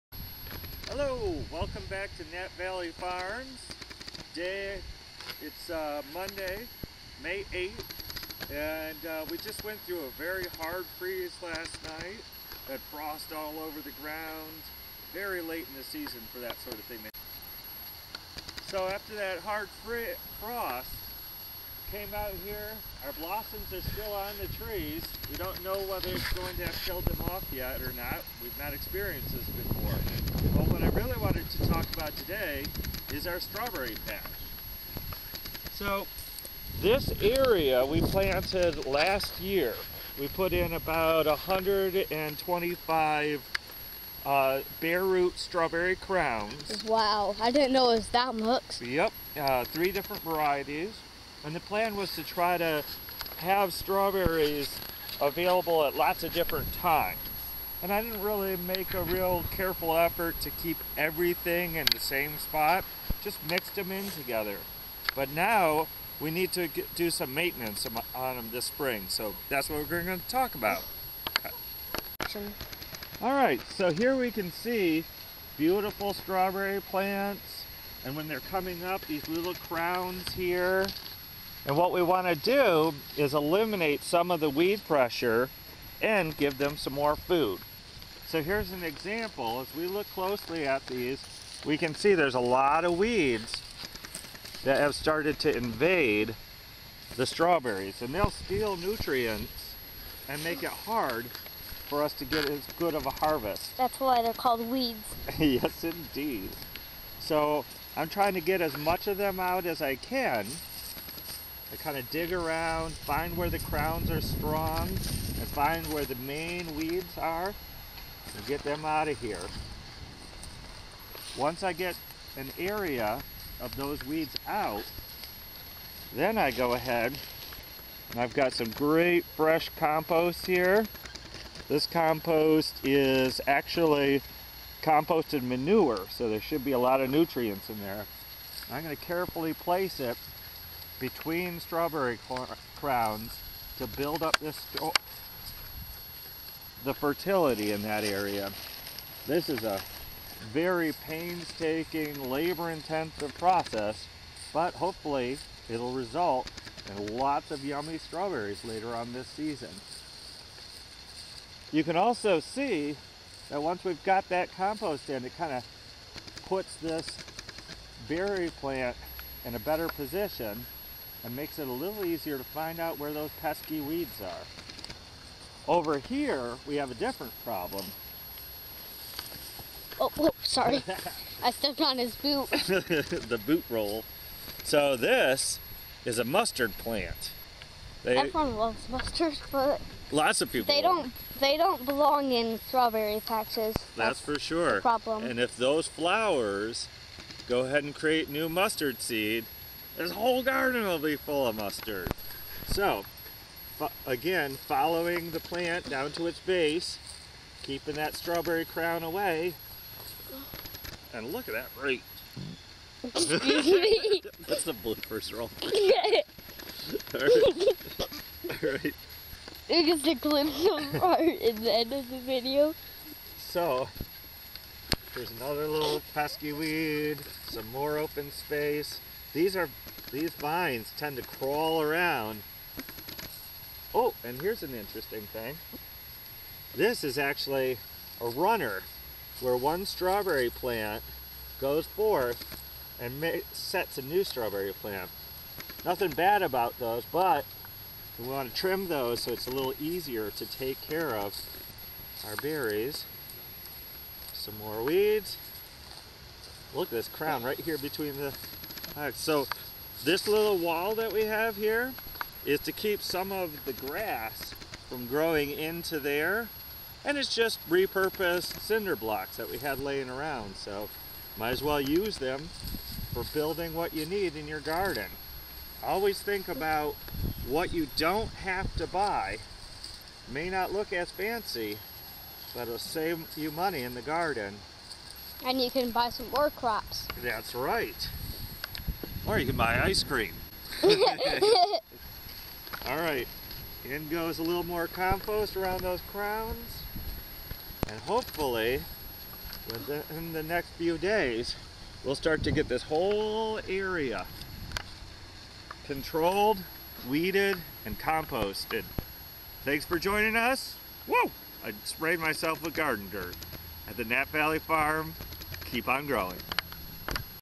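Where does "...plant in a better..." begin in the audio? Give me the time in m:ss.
2:48.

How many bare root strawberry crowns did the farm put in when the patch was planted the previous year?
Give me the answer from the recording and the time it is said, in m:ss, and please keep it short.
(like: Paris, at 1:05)
125, at 0:41.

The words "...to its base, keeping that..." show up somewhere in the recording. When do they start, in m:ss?
3:26.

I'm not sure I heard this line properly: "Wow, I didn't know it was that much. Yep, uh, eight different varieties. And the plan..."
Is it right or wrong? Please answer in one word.
wrong.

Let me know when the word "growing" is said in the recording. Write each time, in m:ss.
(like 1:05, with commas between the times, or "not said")
4:25, 5:16.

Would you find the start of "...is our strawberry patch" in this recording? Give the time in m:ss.
0:33.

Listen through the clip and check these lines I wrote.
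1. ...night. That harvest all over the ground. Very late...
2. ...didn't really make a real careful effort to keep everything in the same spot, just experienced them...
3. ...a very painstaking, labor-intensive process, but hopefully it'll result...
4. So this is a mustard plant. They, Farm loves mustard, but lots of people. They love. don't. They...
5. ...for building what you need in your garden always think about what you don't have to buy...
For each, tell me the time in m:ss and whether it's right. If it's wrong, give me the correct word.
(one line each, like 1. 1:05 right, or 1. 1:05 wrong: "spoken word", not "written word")
1. 0:11 wrong: "frost", not "harvest"
2. 0:58 wrong: "mixed", not "experienced"
3. 2:29 right
4. 3:04 wrong: "Everyone", not "Farm"
5. 4:33 right.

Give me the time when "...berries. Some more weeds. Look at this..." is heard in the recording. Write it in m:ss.
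4:12.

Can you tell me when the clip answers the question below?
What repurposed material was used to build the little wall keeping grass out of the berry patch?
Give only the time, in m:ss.
4:28.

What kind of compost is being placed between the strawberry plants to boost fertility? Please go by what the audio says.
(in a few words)
Composted manure.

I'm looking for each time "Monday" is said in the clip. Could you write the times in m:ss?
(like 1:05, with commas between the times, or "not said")
0:06.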